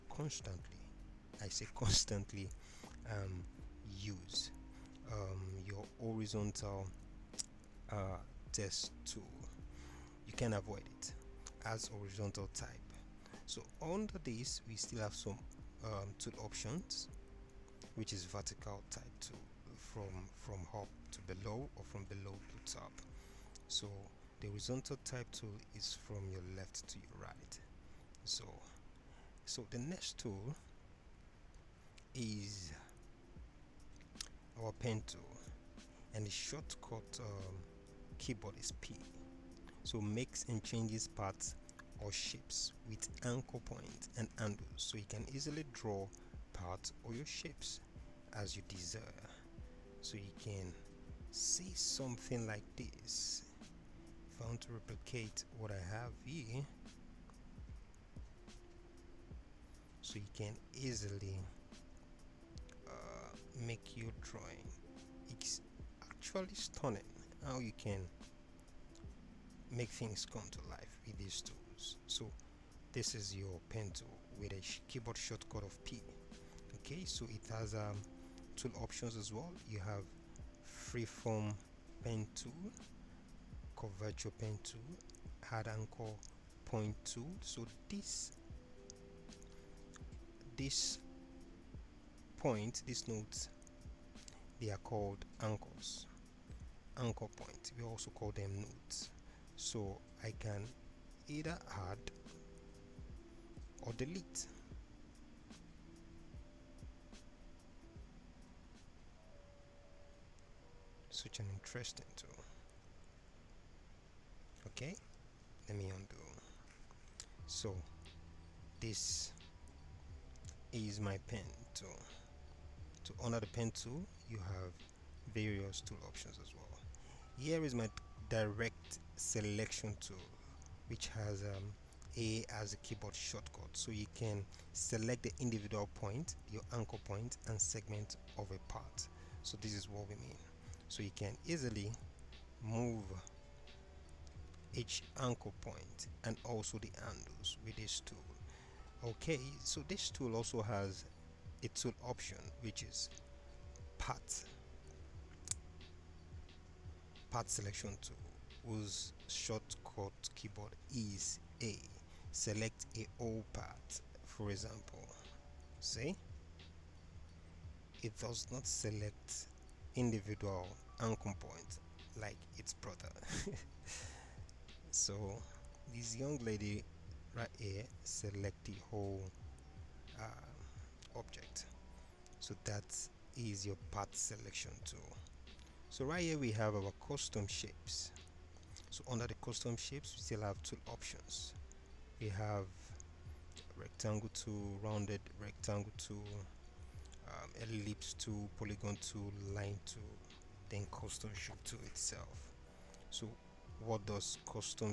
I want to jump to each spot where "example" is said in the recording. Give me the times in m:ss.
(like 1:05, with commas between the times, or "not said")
2:44.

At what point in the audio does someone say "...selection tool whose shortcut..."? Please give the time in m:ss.
2:37.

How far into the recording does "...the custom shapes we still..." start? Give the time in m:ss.
3:09.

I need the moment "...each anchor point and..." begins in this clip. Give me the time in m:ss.
2:24.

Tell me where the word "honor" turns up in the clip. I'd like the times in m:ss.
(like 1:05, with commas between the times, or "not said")
2:03.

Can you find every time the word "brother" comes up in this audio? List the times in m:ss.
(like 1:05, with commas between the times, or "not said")
2:52.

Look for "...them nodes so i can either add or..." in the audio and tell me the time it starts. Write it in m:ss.
1:38.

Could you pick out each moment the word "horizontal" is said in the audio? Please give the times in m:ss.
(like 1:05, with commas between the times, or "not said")
0:05, 0:11, 0:24.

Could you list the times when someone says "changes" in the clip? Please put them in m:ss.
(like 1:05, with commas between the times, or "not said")
0:40.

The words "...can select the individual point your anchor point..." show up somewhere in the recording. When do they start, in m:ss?
2:14.